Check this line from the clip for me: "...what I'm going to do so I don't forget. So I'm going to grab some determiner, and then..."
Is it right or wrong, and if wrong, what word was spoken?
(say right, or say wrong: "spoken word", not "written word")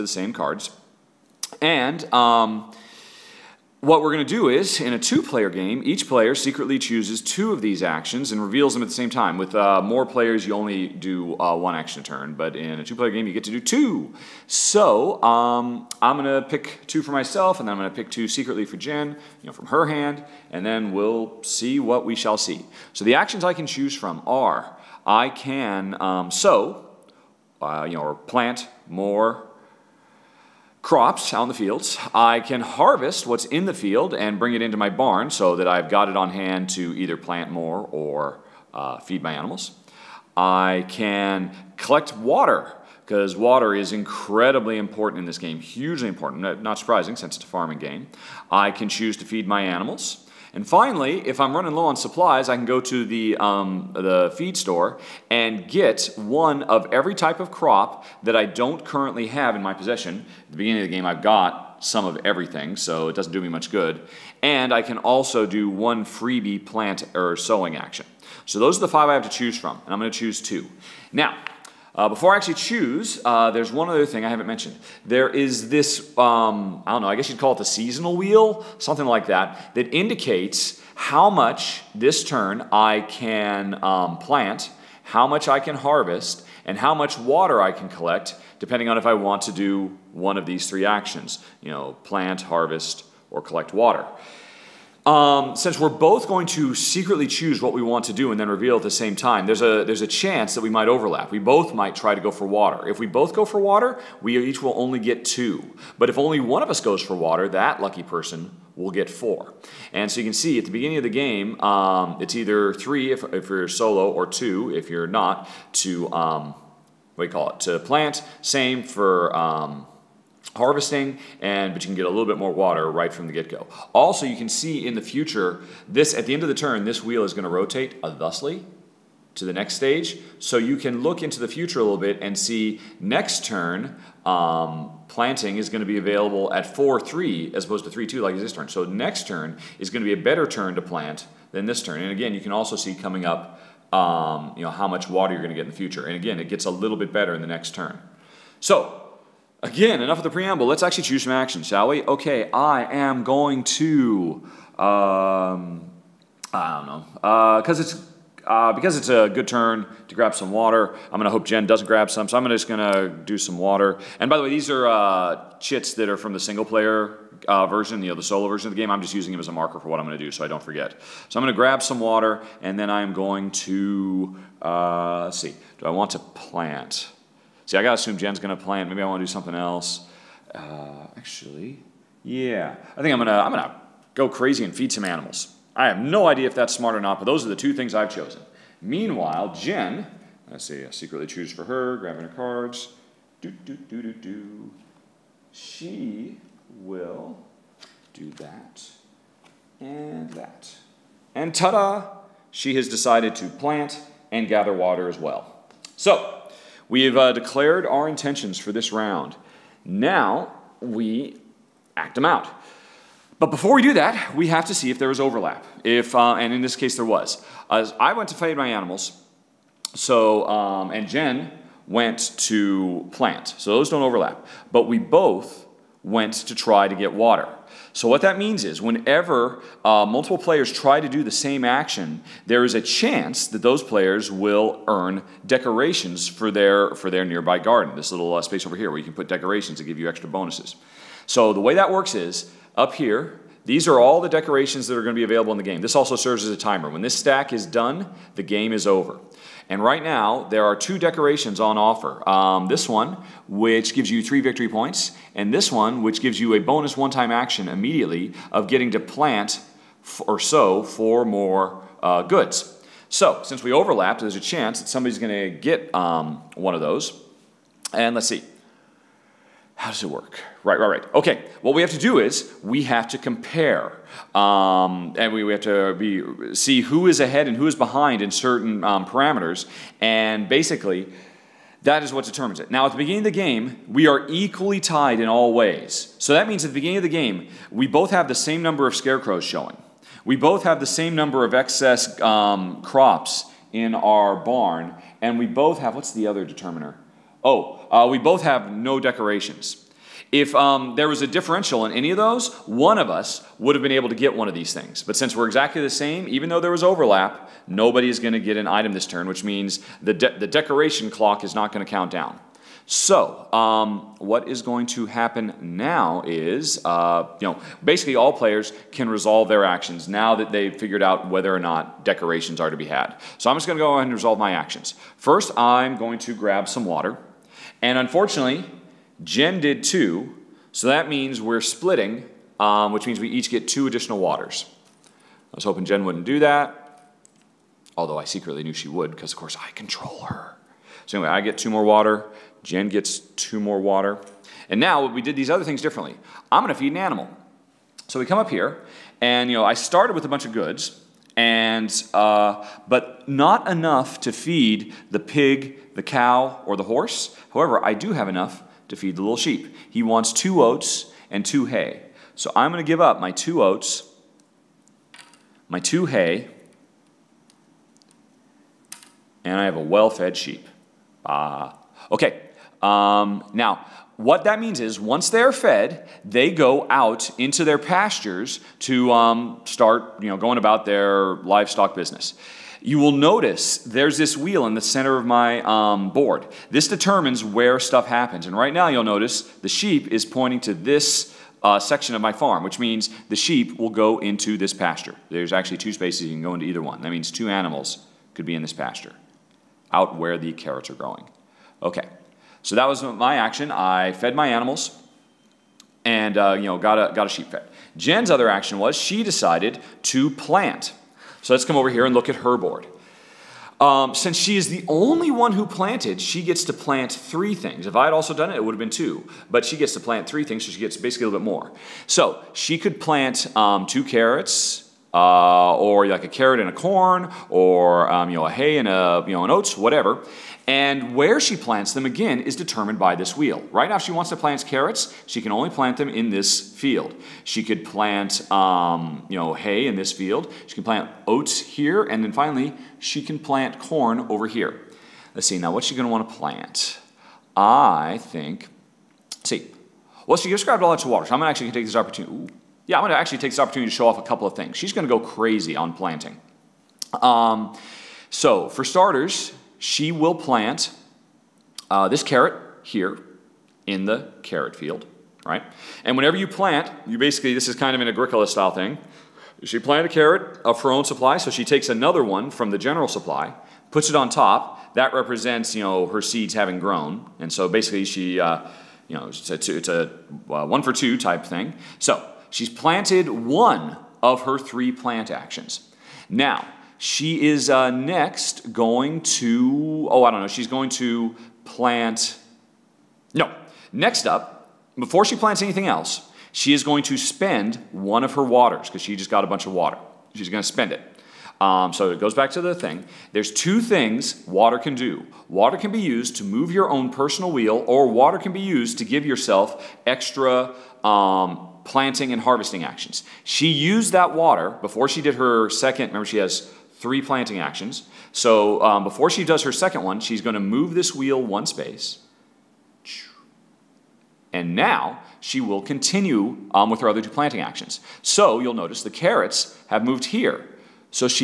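wrong: "water", not "determiner".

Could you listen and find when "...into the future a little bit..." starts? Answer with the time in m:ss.
2:11.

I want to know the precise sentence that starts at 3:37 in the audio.
As I went to feed my animals, so, um, and Jen went to plant.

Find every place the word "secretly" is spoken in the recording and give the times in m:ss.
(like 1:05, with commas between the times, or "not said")
0:06, 0:18, 1:36, 3:10, 5:38.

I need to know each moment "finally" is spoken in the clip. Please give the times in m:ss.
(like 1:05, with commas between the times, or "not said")
0:50, 7:22.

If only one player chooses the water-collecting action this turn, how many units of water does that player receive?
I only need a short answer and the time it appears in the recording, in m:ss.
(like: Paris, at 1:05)
4, at 1:47.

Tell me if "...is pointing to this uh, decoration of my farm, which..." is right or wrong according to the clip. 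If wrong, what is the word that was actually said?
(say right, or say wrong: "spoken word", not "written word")
wrong: "section", not "decoration".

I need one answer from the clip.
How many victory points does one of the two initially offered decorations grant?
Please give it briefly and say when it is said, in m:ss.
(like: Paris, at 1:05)
3, at 4:14.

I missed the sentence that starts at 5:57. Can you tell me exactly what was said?
However, I do have enough to feed the little sheep.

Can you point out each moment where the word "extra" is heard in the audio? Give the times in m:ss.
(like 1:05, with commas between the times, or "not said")
4:00, 8:30.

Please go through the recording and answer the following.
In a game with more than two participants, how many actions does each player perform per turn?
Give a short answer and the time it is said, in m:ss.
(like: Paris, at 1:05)
1, at 0:11.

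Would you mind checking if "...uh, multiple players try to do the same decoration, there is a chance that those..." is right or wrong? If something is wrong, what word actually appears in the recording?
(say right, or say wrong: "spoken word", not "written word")
wrong: "action", not "decoration".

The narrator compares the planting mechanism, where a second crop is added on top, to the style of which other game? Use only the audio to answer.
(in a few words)
Agricola.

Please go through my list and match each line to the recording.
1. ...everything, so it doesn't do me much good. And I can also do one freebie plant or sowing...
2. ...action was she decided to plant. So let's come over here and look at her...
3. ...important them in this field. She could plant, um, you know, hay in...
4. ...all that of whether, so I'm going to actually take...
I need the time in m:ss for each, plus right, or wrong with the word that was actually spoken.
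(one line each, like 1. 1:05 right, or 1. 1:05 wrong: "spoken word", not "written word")
1. 1:02 right
2. 6:48 right
3. 7:15 wrong: "plant", not "important"
4. 7:30 wrong: "water", not "whether".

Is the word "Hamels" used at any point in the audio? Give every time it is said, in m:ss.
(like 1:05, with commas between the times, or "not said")
not said.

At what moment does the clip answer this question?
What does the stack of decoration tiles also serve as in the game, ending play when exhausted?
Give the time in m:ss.
4:06.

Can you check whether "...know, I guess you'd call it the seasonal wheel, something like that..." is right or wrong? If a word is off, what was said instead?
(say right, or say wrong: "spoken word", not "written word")
right.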